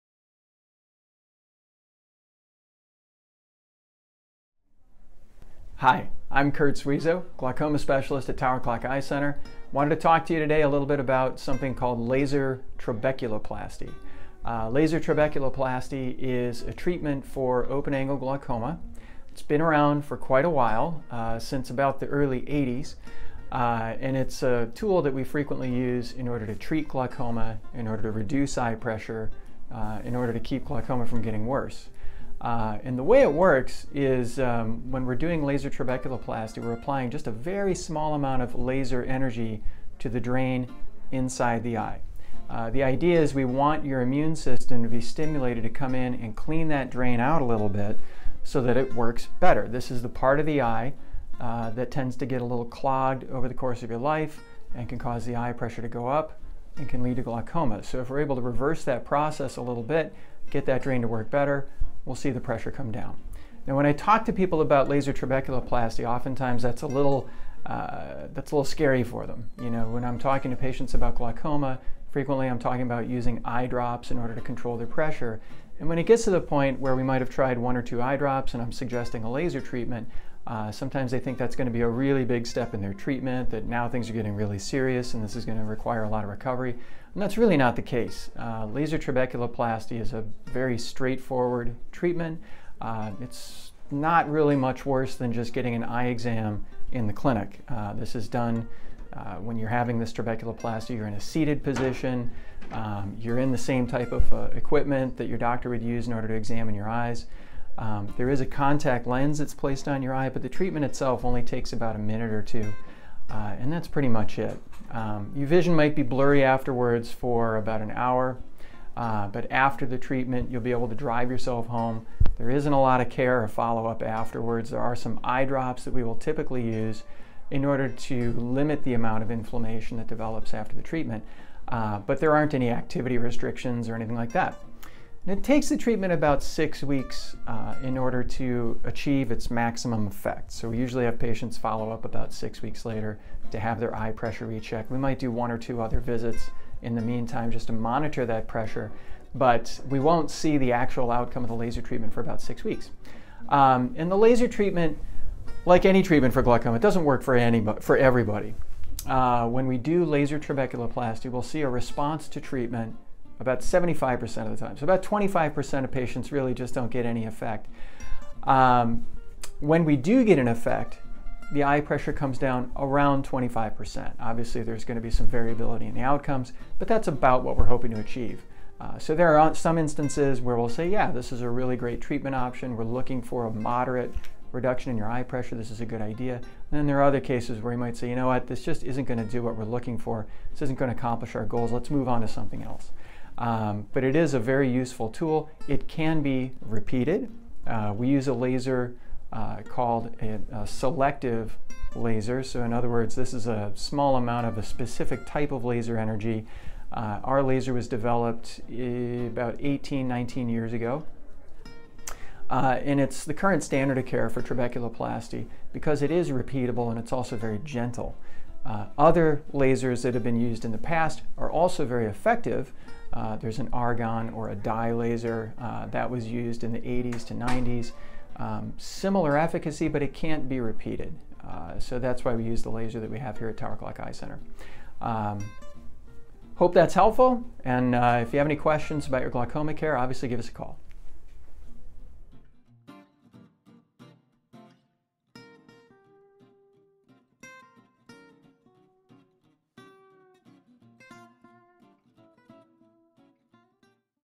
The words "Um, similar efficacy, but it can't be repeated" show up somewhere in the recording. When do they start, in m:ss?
3:48.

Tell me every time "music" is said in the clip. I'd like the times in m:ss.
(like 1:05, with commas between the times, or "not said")
not said.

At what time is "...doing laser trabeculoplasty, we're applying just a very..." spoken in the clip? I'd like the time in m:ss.
0:35.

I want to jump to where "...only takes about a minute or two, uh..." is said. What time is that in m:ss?
1:51.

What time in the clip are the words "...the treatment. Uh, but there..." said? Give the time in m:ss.
2:10.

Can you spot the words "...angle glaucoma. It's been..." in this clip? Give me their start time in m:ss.
0:17.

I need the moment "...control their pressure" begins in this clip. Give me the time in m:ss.
1:14.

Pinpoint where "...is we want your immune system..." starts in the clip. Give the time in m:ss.
0:43.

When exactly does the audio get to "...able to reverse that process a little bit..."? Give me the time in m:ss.
0:58.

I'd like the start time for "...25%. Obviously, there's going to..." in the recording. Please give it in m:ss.
2:53.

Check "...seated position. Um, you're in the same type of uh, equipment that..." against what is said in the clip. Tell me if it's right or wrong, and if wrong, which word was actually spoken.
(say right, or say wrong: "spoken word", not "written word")
right.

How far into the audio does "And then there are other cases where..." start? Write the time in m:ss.
3:06.